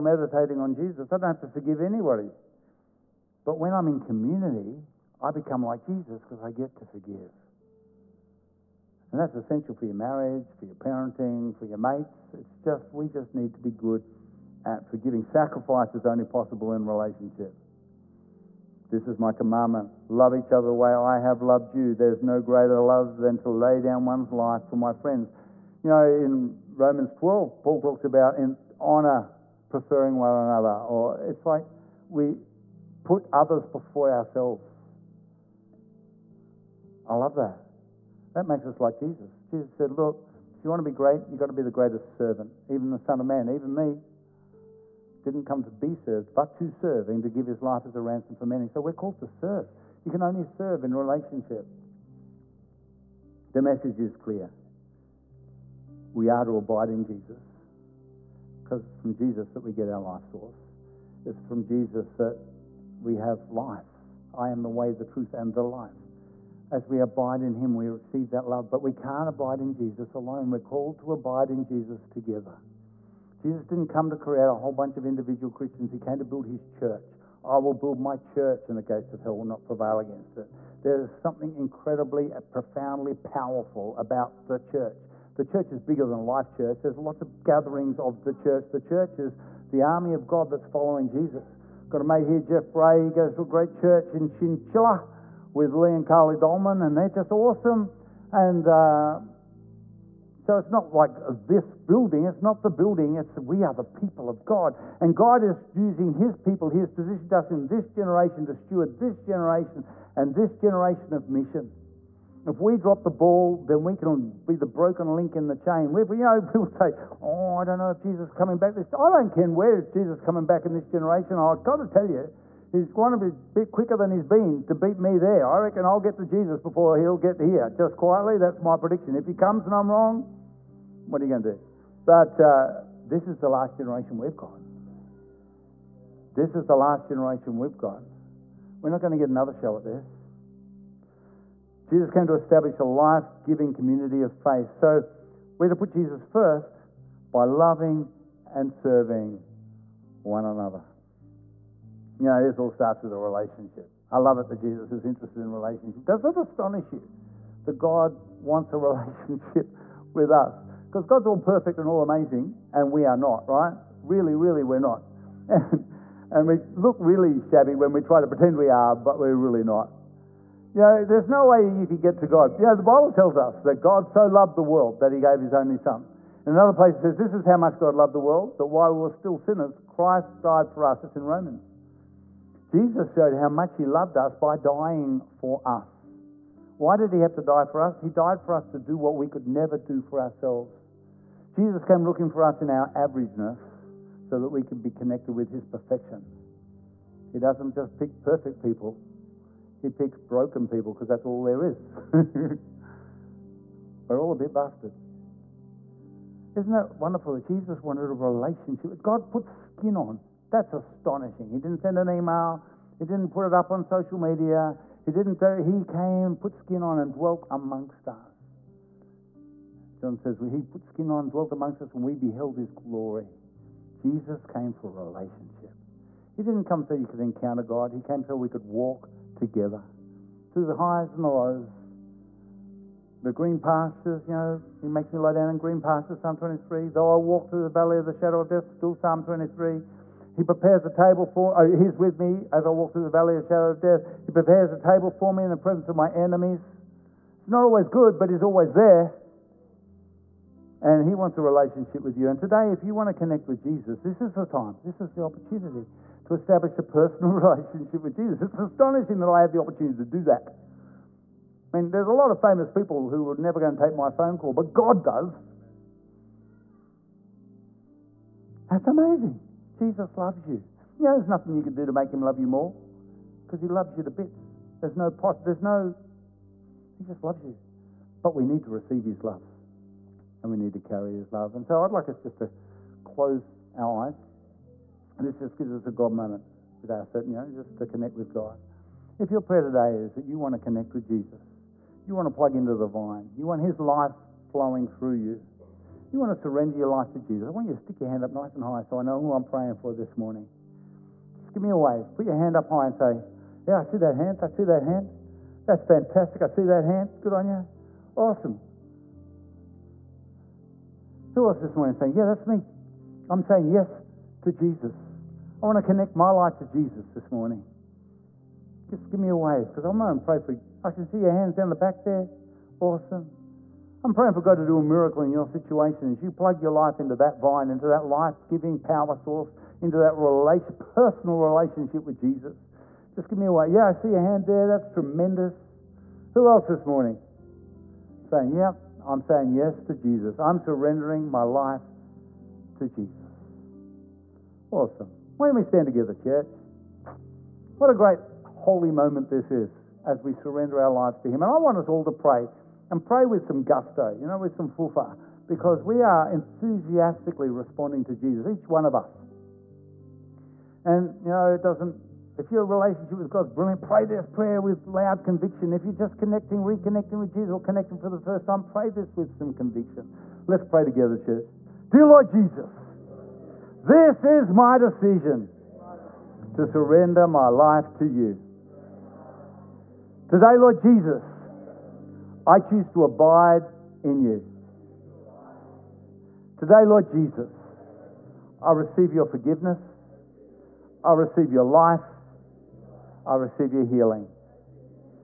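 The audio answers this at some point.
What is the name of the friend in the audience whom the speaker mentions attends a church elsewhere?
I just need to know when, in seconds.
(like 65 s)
92 s.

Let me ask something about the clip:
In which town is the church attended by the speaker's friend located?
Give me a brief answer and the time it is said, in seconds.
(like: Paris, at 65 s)
Chinchilla, at 94 s.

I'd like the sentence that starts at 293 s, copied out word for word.
You want His life flowing through you.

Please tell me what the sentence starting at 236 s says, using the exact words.
Though I walk through the valley of the shadow of death, still Psalm 23.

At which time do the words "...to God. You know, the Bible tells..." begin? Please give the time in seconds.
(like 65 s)
172 s.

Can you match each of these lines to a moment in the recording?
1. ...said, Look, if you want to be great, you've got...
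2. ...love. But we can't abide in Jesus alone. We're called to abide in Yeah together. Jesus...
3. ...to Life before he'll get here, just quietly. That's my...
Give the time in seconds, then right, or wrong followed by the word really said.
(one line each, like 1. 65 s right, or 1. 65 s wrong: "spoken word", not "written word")
1. 39 s right
2. 68 s wrong: "Jesus", not "Yeah"
3. 126 s wrong: "Jesus", not "Life".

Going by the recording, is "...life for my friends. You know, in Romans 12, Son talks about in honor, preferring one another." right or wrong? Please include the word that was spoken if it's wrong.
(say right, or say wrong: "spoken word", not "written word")
wrong: "Paul", not "Son".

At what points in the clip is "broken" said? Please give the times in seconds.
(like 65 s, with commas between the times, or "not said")
114 s, 200 s.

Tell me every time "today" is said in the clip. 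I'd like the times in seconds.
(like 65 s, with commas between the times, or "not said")
252 s, 289 s, 380 s, 386 s.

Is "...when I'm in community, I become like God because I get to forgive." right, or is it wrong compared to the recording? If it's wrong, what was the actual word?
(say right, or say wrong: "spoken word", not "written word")
wrong: "Jesus", not "God".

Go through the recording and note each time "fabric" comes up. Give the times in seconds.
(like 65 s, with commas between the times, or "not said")
not said.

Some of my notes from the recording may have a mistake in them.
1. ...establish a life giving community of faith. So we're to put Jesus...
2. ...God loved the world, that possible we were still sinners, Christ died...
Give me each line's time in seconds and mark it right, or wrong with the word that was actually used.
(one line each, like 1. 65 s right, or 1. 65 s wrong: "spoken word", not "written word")
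1. 142 s right
2. 177 s wrong: "while", not "possible".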